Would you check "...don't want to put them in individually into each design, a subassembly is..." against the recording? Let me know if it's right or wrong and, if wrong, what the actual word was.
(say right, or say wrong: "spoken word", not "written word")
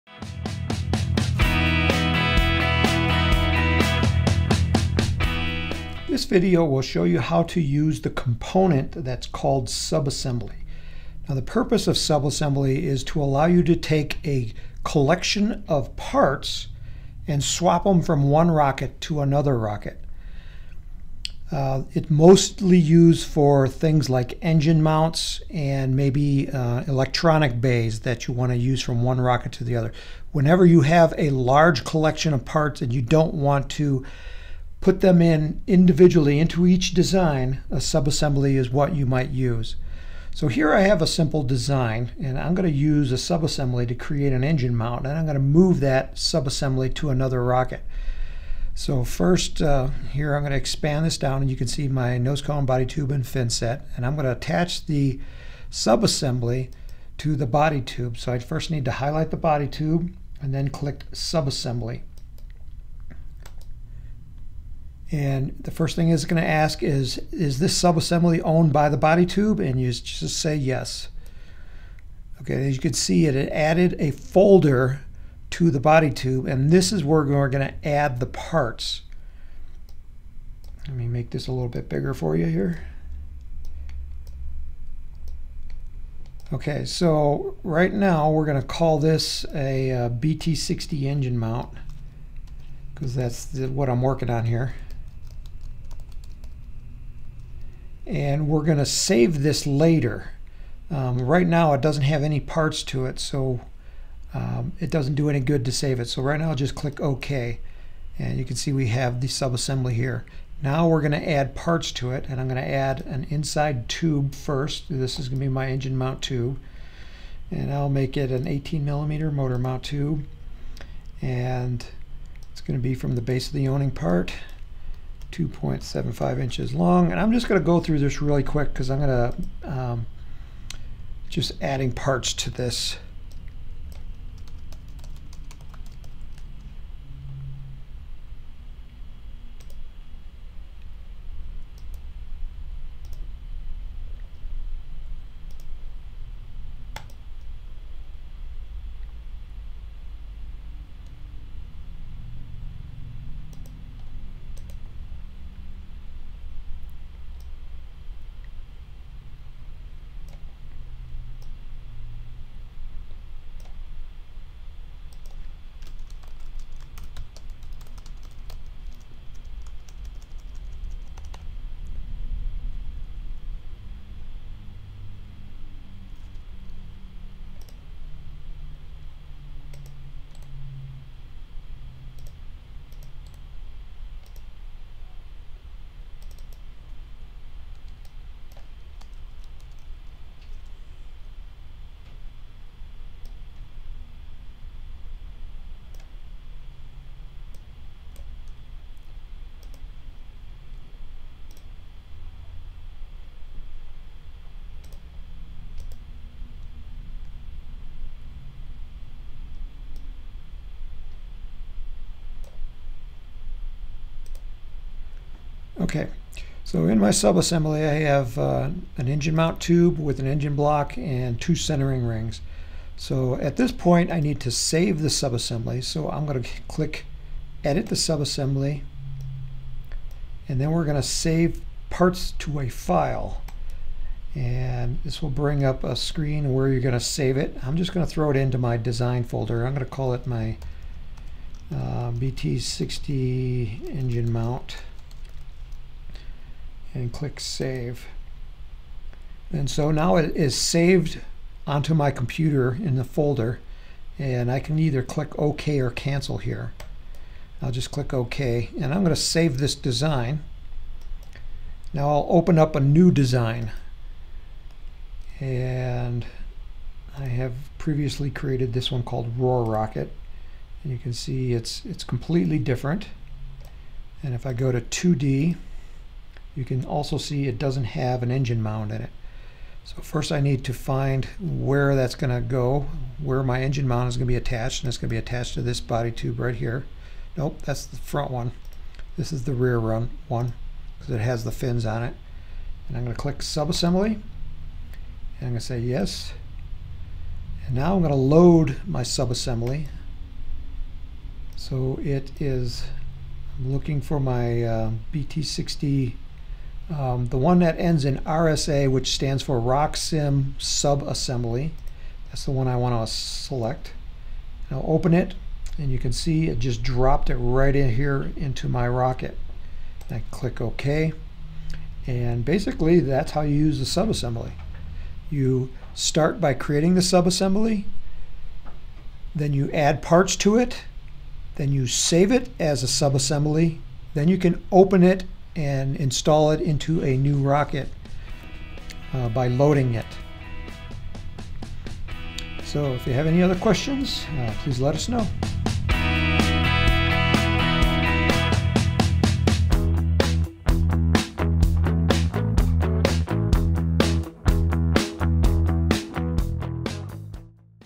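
right.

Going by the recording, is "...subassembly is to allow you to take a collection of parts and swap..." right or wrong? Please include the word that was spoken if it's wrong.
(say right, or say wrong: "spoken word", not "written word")
right.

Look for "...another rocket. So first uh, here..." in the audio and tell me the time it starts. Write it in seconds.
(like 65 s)
47 s.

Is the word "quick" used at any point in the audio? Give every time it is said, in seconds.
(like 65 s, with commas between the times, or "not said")
128 s.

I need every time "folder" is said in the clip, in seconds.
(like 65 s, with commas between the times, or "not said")
74 s, 239 s, 253 s.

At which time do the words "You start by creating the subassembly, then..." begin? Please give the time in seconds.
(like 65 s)
325 s.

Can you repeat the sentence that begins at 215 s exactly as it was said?
Okay, so in my subassembly I have uh, an engine mount tube with an engine block and two centering rings.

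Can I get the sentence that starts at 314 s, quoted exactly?
Now open it, and you can see it just dropped it right in here into my rocket.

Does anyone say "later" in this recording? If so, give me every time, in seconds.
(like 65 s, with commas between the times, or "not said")
99 s.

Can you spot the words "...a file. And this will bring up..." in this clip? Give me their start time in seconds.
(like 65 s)
232 s.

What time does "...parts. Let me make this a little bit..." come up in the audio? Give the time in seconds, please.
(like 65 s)
78 s.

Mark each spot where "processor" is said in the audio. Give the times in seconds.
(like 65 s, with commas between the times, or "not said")
not said.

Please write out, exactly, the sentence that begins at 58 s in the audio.
So I first need to highlight the body tube and then click subassembly.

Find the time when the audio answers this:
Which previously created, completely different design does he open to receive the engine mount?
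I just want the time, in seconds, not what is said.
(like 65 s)
269 s.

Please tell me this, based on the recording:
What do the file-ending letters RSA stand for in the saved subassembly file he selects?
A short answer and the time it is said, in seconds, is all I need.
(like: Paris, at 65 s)
RockSim Subassembly, at 309 s.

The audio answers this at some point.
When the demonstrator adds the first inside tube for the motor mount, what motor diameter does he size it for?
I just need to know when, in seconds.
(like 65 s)
118 s.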